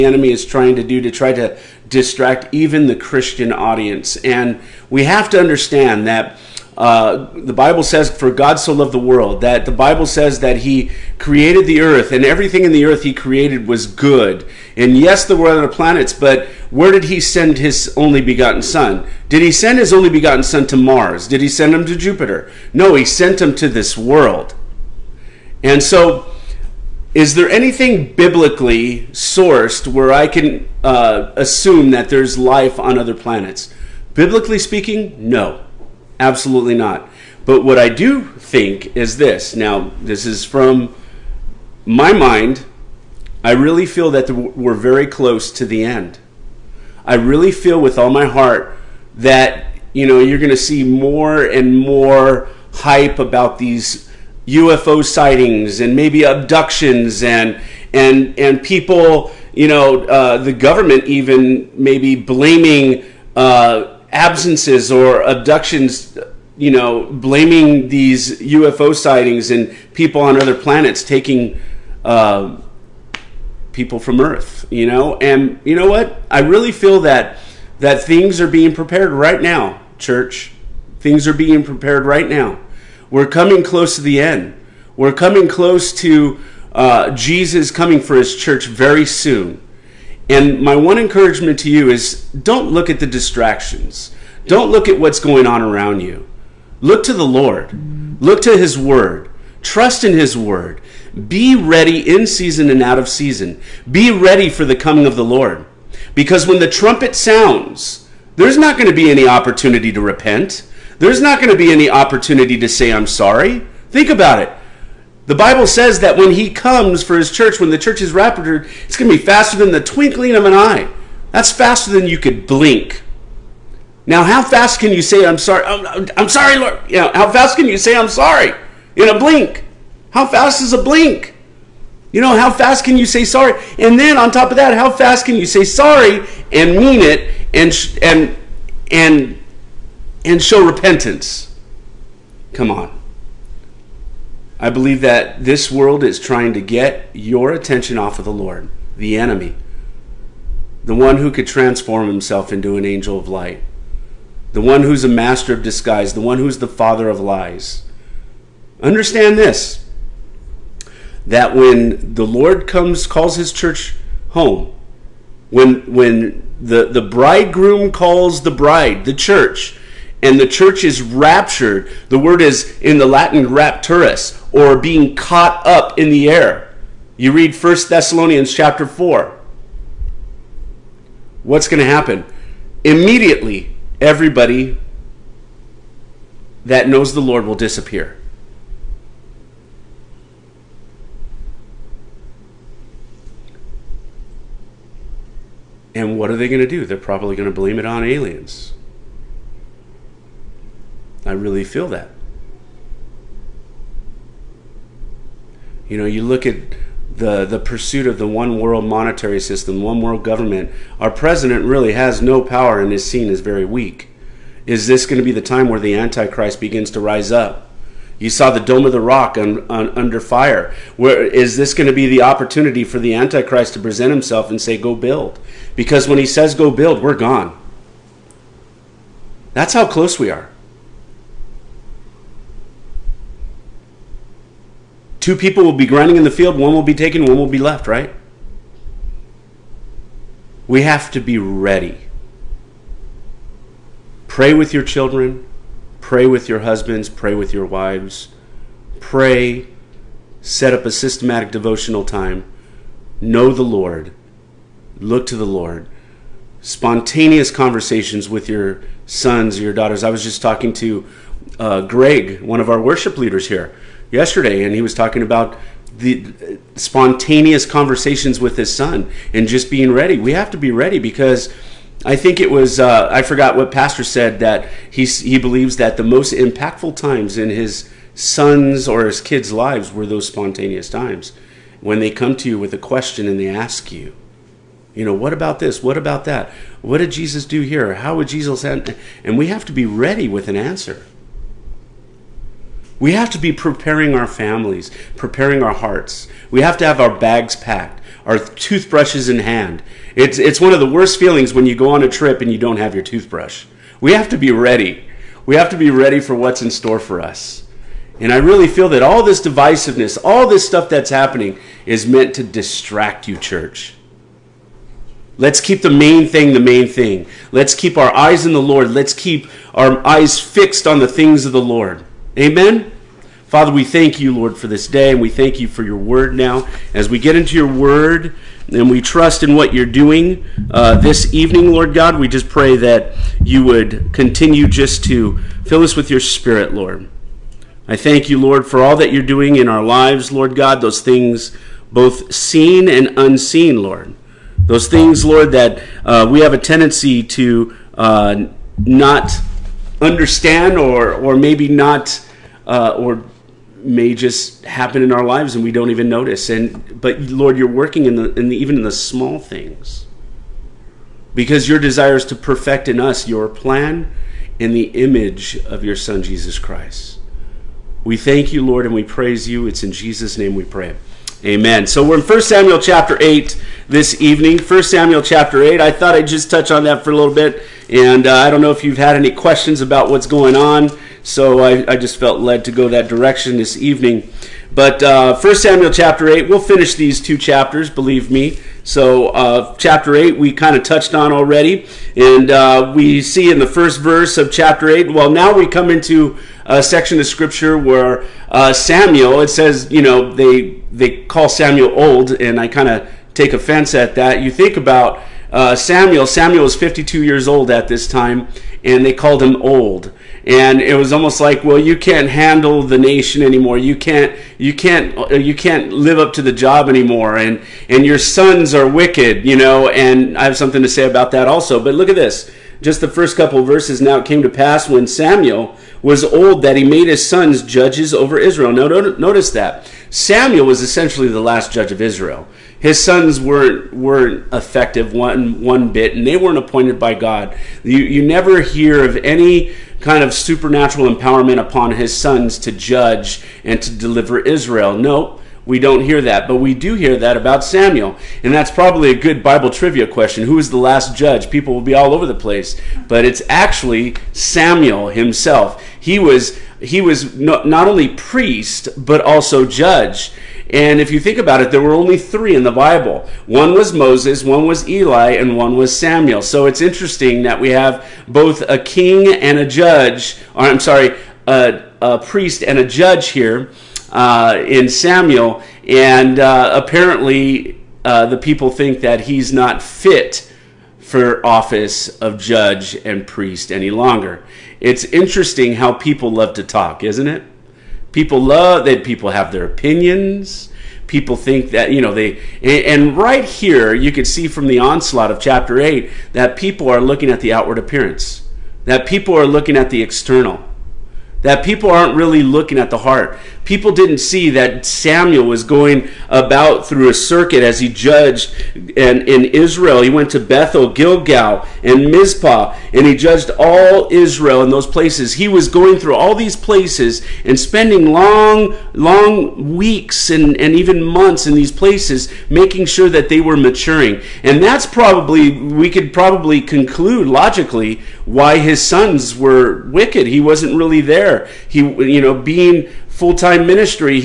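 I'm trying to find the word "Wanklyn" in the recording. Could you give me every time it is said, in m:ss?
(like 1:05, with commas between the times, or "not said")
not said.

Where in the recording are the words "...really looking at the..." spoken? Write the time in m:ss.
8:22.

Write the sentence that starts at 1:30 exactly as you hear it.
And my one encouragement to you is don't look at the distractions.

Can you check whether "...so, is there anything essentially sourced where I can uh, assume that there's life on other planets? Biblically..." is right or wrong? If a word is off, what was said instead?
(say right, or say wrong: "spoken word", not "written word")
wrong: "biblically", not "essentially".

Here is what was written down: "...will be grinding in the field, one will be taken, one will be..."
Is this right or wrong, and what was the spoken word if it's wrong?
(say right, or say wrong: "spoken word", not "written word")
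right.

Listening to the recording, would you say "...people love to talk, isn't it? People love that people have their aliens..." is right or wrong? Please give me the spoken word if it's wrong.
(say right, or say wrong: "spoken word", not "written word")
wrong: "opinions", not "aliens".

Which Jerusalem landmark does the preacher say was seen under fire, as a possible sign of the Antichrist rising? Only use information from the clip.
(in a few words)
Dome of the Rock.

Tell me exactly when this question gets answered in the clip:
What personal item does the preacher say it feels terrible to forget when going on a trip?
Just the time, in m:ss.
5:03.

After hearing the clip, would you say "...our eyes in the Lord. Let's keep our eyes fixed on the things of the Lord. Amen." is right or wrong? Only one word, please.
right.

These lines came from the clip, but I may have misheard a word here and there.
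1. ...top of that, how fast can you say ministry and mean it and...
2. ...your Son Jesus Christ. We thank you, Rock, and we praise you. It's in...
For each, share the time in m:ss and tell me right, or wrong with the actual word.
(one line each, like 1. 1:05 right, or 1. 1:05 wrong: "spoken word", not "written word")
1. 2:14 wrong: "sorry", not "ministry"
2. 6:05 wrong: "Lord", not "Rock".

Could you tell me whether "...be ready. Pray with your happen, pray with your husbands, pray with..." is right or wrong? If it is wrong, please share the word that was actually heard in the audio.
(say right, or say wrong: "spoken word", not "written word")
wrong: "children", not "happen".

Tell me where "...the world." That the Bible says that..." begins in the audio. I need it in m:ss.
0:08.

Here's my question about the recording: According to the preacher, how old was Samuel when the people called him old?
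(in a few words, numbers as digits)
52.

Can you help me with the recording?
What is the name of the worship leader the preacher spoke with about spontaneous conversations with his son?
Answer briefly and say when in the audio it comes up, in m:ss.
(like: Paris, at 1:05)
Greg, at 4:21.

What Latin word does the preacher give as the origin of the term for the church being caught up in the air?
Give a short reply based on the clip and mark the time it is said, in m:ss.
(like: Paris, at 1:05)
rapturus, at 2:53.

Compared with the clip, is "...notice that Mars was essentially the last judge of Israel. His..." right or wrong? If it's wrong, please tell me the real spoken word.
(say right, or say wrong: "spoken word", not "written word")
wrong: "Samuel", not "Mars".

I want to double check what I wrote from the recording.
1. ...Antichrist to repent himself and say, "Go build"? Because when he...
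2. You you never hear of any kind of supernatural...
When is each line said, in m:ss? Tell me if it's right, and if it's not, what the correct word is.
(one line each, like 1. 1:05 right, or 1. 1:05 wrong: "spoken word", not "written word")
1. 3:43 wrong: "present", not "repent"
2. 7:17 right.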